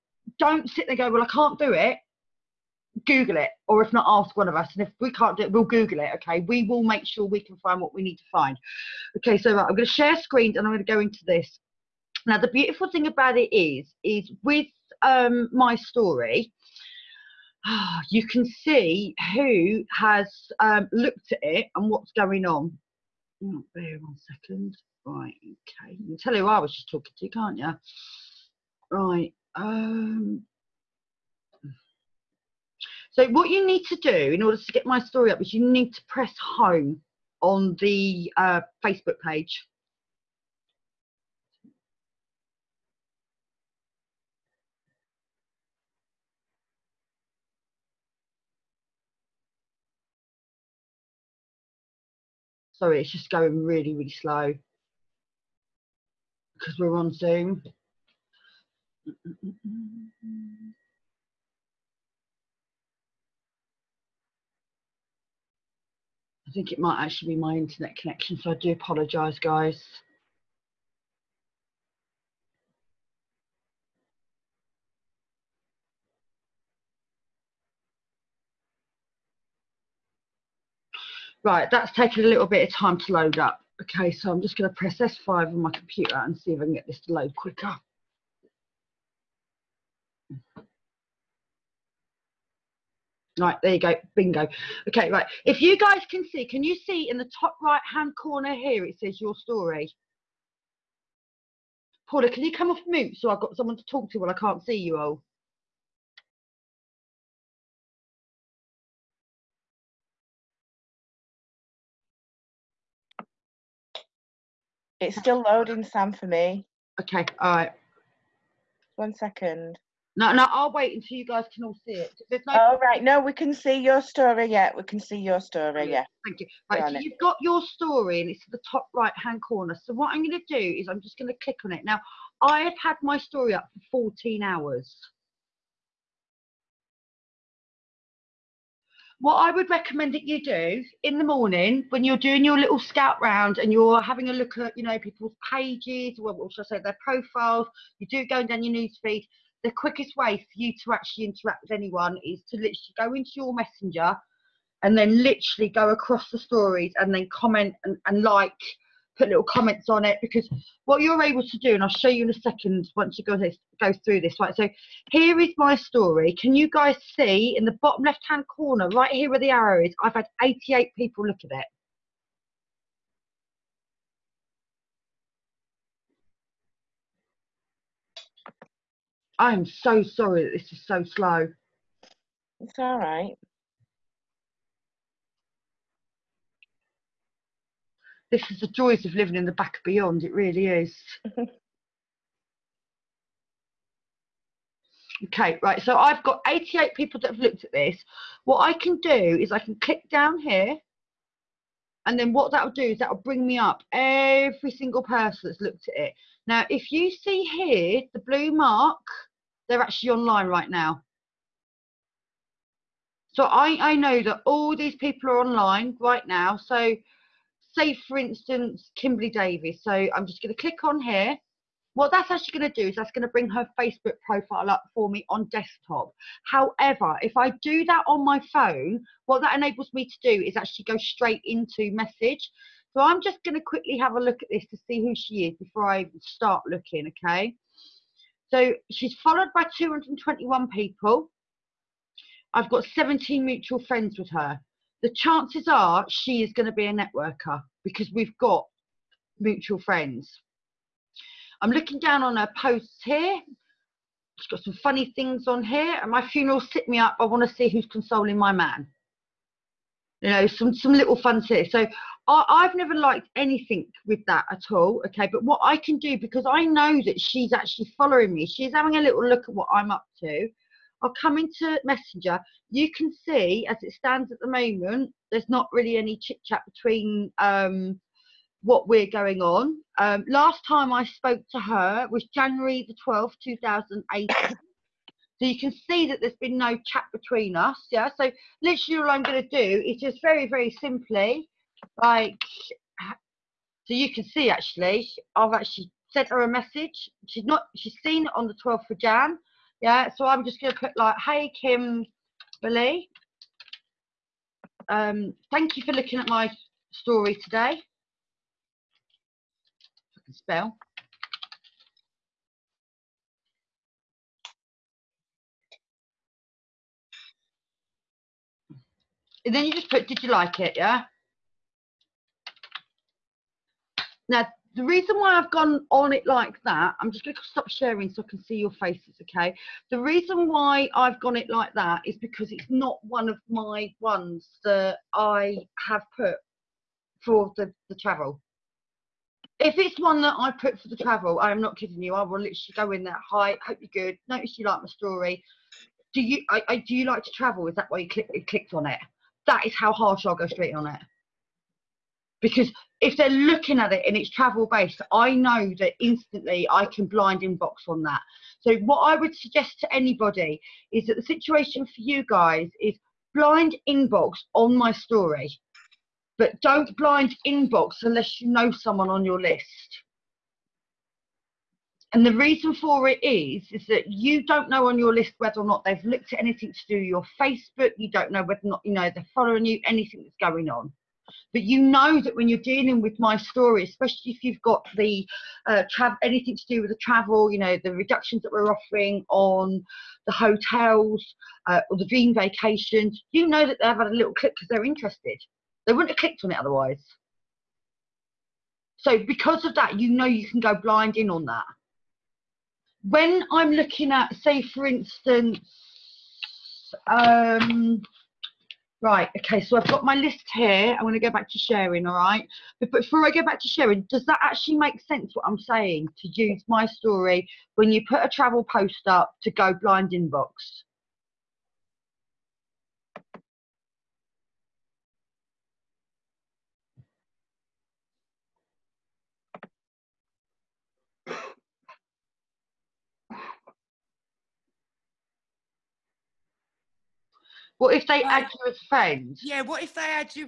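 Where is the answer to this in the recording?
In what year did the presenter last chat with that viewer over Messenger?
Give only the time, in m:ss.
4:43.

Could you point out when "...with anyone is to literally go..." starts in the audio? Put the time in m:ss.
2:31.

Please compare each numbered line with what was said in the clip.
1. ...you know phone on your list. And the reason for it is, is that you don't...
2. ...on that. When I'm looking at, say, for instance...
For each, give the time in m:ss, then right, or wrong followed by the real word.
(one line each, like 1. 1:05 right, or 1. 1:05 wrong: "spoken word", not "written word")
1. 6:08 wrong: "someone", not "phone"
2. 6:41 right.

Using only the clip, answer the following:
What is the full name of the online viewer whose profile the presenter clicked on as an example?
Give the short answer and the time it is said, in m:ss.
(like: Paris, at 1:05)
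Kimberly Davis, at 3:38.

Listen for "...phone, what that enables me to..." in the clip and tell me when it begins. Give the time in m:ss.
3:48.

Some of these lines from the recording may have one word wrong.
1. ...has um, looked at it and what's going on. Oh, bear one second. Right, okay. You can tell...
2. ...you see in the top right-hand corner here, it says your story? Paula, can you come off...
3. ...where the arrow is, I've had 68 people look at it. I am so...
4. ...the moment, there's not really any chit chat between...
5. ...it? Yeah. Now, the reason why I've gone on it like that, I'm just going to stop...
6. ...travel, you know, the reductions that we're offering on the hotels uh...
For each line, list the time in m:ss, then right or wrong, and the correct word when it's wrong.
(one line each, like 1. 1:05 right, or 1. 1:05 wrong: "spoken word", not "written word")
1. 0:19 right
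2. 1:36 right
3. 2:49 wrong: "88", not "68"
4. 4:34 right
5. 5:20 right
6. 6:27 right.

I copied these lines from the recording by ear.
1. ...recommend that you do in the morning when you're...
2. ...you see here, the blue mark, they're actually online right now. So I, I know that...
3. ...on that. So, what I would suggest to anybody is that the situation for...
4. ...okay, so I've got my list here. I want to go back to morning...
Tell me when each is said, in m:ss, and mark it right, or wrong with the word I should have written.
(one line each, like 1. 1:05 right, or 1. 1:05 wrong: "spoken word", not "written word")
1. 2:19 right
2. 3:26 right
3. 5:57 right
4. 6:49 wrong: "sharing", not "morning".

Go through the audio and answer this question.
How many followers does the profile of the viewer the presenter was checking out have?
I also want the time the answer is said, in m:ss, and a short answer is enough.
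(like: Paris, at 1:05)
221, at 3:59.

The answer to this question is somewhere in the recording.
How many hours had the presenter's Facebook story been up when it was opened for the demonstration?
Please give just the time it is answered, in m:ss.
2:14.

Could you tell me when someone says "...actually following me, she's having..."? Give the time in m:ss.
4:27.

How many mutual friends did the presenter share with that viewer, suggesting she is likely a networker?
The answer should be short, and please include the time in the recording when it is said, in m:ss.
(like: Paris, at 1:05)
17, at 4:02.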